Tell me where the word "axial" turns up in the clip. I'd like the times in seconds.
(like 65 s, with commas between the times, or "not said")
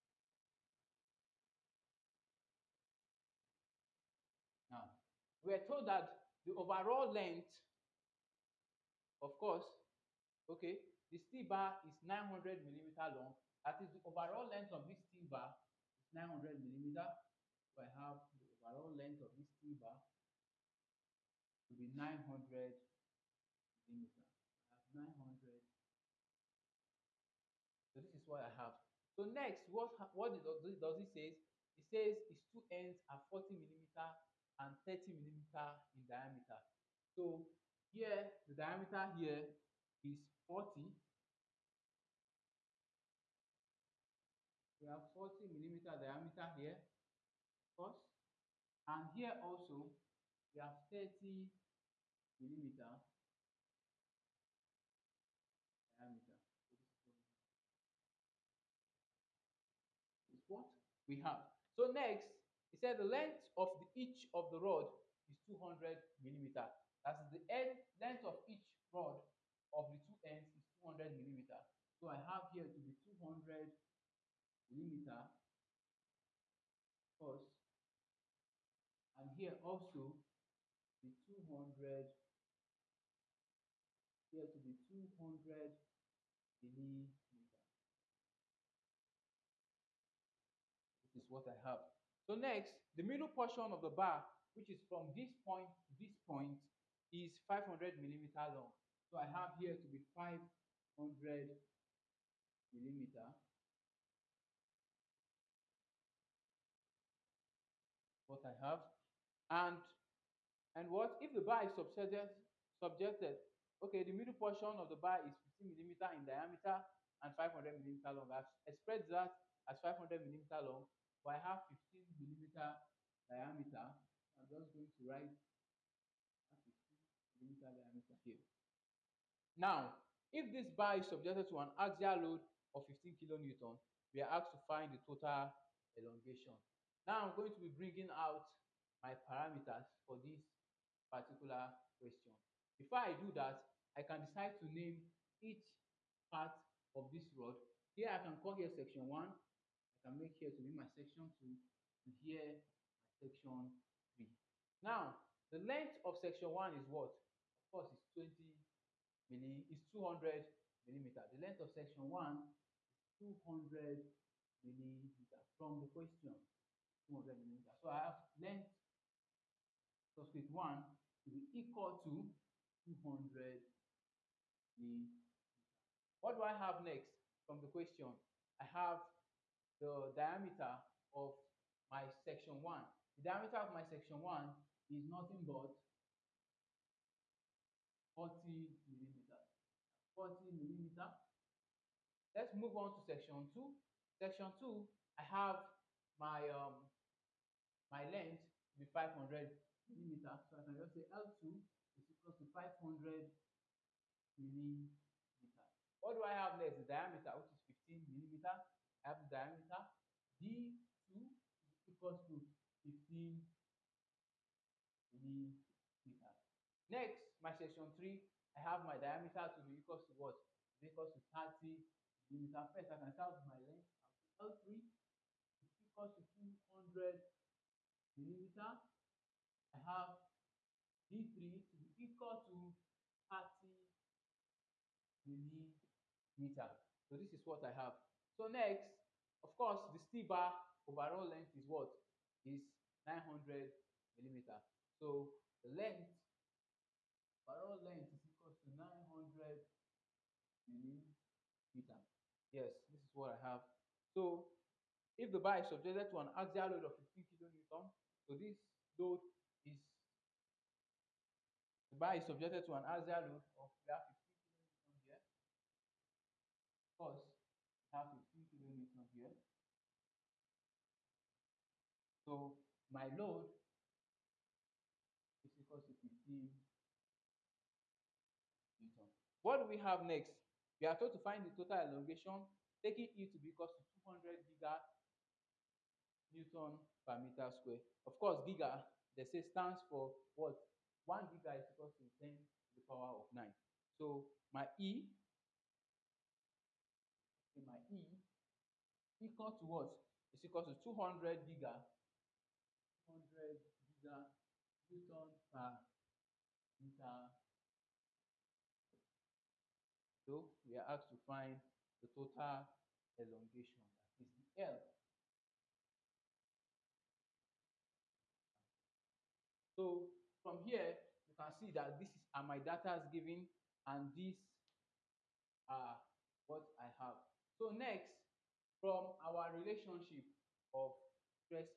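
131 s, 256 s, 262 s.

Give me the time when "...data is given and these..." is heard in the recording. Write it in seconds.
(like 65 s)
322 s.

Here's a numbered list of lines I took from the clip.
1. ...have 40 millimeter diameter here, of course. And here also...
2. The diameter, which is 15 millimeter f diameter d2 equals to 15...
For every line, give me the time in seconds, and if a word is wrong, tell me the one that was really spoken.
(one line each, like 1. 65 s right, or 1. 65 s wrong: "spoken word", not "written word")
1. 44 s right
2. 206 s right.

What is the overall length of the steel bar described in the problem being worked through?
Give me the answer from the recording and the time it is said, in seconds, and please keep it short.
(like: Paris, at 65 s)
900 mm, at 12 s.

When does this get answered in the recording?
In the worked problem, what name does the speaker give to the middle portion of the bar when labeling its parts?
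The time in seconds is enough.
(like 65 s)
150 s.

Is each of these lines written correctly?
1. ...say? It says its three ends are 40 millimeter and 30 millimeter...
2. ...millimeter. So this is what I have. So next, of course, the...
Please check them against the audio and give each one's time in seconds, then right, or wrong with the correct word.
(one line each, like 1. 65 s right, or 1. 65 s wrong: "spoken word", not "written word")
1. 31 s wrong: "two", not "three"
2. 236 s right.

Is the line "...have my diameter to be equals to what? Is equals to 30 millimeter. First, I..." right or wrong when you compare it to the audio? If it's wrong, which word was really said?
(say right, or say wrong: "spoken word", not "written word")
right.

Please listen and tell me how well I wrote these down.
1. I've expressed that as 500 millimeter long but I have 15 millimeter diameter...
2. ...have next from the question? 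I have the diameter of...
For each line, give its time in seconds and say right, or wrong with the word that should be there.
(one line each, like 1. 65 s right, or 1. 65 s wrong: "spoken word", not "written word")
1. 118 s right
2. 176 s right.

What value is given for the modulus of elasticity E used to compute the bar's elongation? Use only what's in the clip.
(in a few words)
200 GN/m².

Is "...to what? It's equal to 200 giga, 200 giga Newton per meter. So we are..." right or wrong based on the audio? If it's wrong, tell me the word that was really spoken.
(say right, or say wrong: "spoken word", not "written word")
right.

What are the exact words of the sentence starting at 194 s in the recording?
Section two, I have my um, my length will be 500 millimeter.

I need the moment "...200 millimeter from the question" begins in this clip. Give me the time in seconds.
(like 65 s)
163 s.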